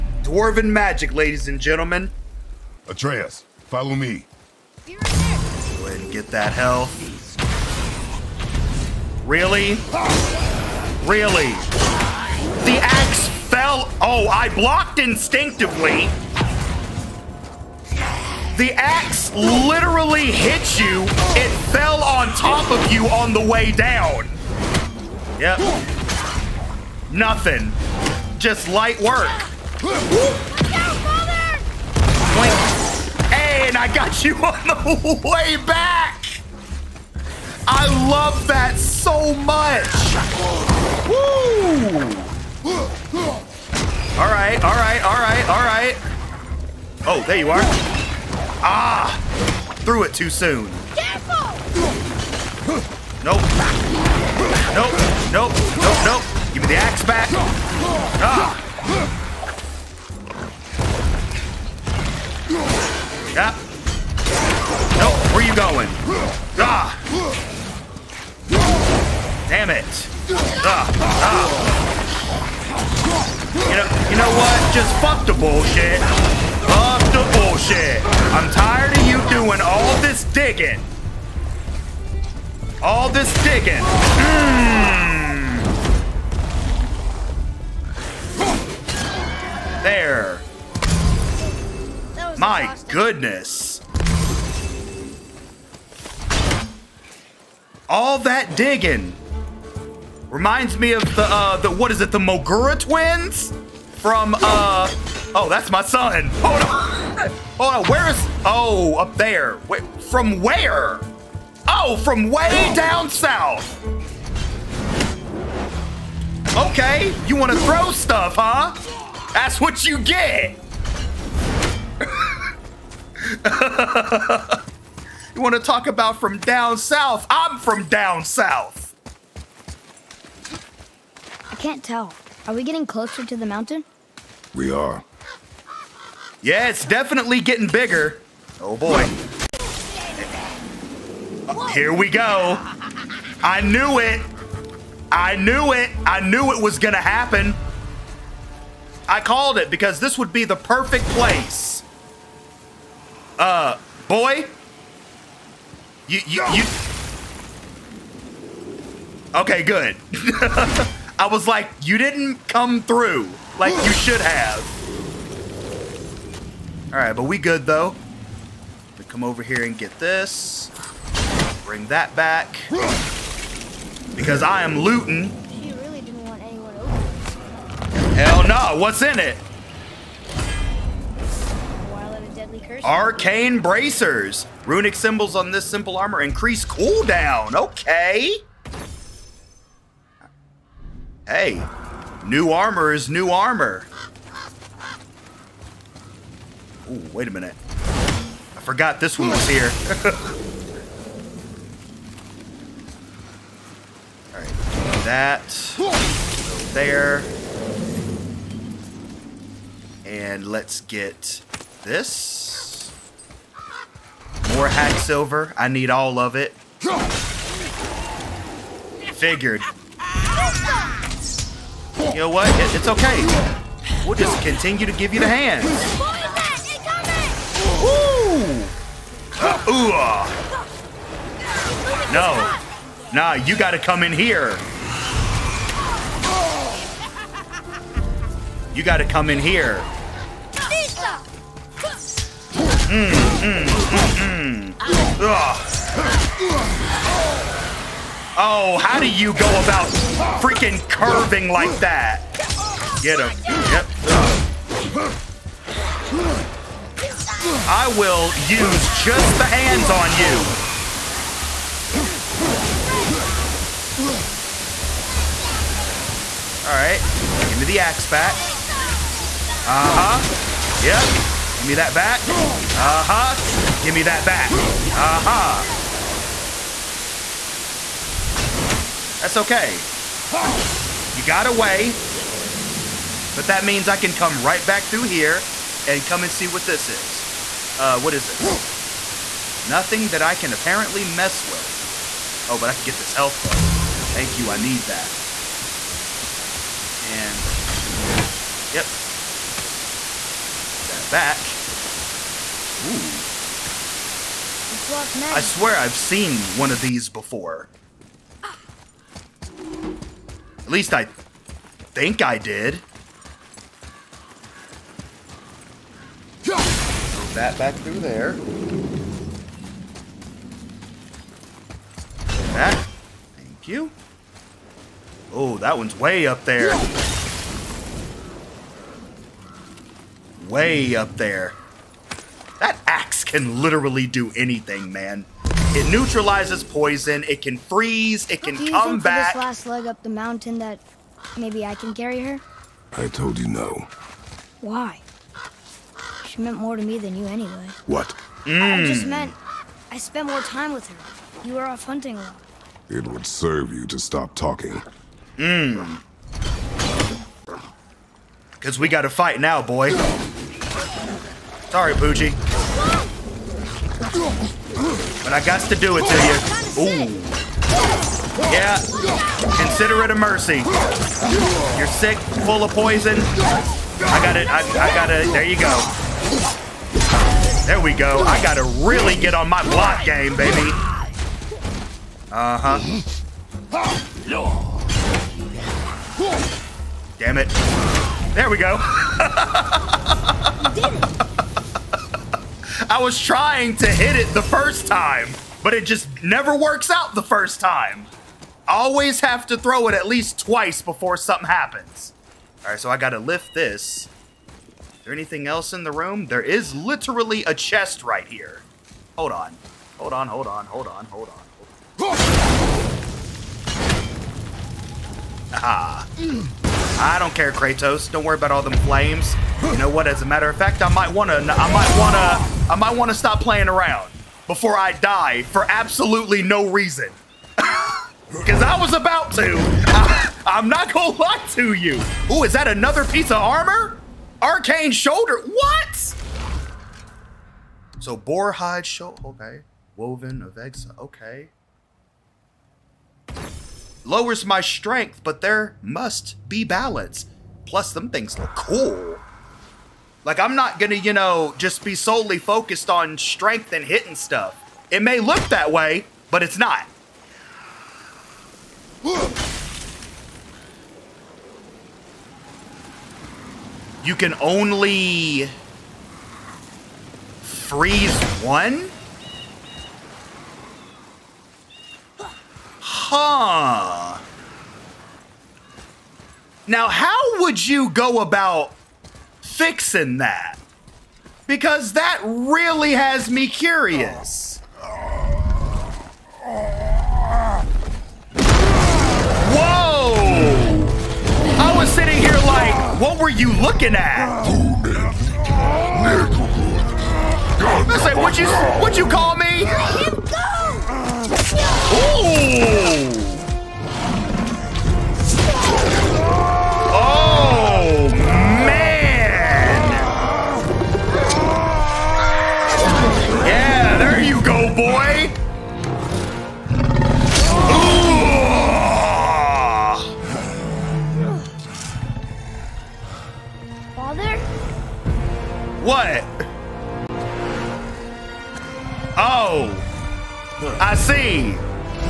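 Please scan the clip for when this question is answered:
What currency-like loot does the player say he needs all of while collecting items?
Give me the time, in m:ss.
3:34.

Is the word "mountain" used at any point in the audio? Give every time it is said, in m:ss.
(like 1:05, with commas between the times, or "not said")
2:13, 5:40.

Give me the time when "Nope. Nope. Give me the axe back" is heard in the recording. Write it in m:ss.
0:55.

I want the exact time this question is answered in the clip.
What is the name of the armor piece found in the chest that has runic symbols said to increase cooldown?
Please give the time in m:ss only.
3:02.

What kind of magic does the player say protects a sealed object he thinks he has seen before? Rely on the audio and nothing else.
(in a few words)
Locked magic.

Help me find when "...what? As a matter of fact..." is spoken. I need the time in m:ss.
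6:59.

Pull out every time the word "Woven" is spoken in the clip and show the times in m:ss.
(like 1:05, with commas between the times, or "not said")
7:19.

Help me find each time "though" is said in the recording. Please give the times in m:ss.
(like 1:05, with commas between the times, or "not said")
2:47, 4:53.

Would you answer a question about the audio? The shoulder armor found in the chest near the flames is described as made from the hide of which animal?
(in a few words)
Boar.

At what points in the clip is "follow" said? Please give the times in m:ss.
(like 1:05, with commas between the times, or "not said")
0:03.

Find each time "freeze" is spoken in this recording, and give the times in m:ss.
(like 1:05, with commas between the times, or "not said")
5:37, 7:47.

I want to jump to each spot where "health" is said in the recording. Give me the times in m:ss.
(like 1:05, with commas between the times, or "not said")
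0:06, 4:53.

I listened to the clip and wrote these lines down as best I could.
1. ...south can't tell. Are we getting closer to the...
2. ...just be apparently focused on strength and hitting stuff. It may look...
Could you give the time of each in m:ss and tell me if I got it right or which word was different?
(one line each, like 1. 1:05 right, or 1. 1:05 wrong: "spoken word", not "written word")
1. 2:08 right
2. 7:31 wrong: "solely", not "apparently".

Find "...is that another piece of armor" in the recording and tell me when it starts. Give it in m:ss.
7:12.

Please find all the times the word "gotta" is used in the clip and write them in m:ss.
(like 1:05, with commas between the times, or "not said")
3:53, 3:58.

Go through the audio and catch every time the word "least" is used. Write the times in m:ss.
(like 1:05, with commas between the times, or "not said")
5:10, 6:40.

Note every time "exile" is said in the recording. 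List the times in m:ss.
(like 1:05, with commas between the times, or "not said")
7:20.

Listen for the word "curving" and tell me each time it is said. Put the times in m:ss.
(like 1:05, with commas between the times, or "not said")
4:10.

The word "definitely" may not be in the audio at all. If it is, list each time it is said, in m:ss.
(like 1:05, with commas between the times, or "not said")
2:16.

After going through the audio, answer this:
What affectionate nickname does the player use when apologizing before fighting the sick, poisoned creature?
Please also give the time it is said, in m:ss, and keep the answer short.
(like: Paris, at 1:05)
Poochie, at 6:01.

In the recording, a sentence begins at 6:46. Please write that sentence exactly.
There is literally a chest right here.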